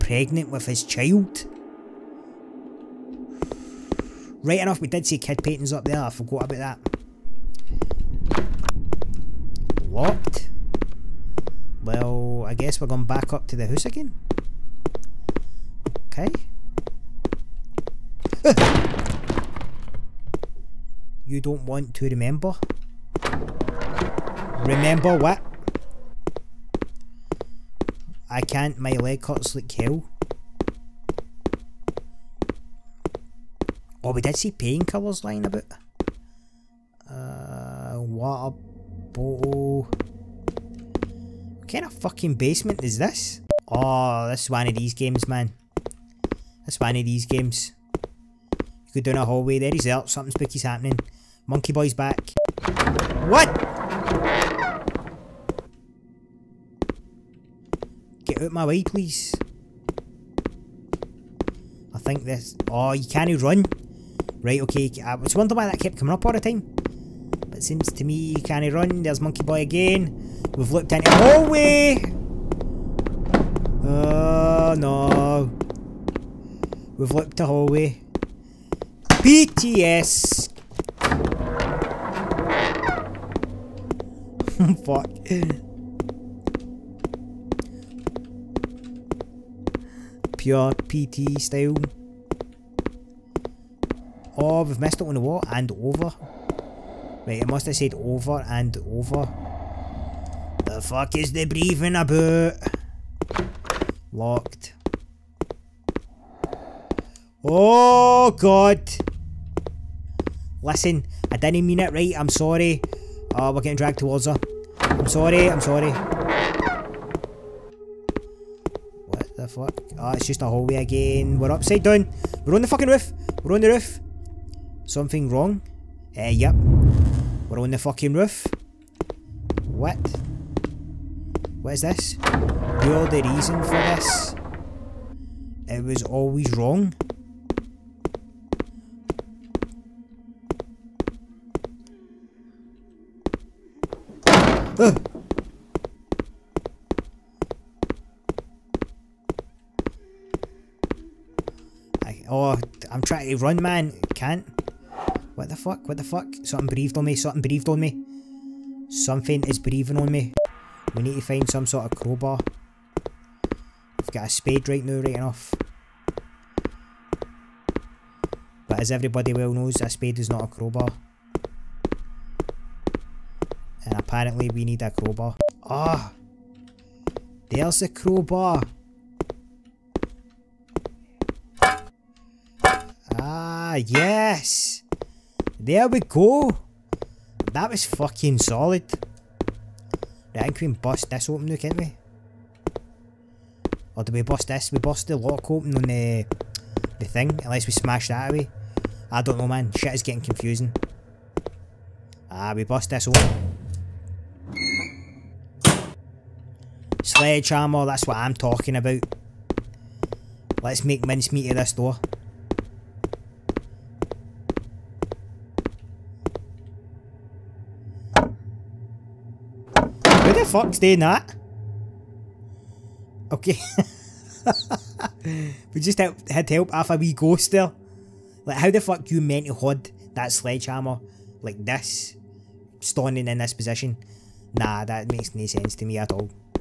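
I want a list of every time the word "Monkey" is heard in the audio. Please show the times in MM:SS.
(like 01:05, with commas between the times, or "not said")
00:51, 01:09.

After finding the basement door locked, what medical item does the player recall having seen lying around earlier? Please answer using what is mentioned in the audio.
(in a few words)
Painkillers.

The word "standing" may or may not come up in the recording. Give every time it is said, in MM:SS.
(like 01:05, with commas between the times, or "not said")
03:52.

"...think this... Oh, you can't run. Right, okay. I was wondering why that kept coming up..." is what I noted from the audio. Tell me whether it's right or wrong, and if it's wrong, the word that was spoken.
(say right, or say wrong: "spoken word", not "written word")
right.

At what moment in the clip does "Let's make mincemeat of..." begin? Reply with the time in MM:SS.
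03:30.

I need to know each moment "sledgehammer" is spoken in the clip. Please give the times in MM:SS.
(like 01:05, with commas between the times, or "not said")
03:27, 03:50.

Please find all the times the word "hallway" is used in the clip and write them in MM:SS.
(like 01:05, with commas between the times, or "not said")
00:49, 01:11, 01:17, 02:00.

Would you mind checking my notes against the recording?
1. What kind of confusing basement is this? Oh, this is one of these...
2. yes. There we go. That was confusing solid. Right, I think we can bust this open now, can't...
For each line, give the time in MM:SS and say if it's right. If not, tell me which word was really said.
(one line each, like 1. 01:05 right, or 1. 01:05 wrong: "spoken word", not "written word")
1. 00:39 wrong: "fucking", not "confusing"
2. 03:03 wrong: "fucking", not "confusing".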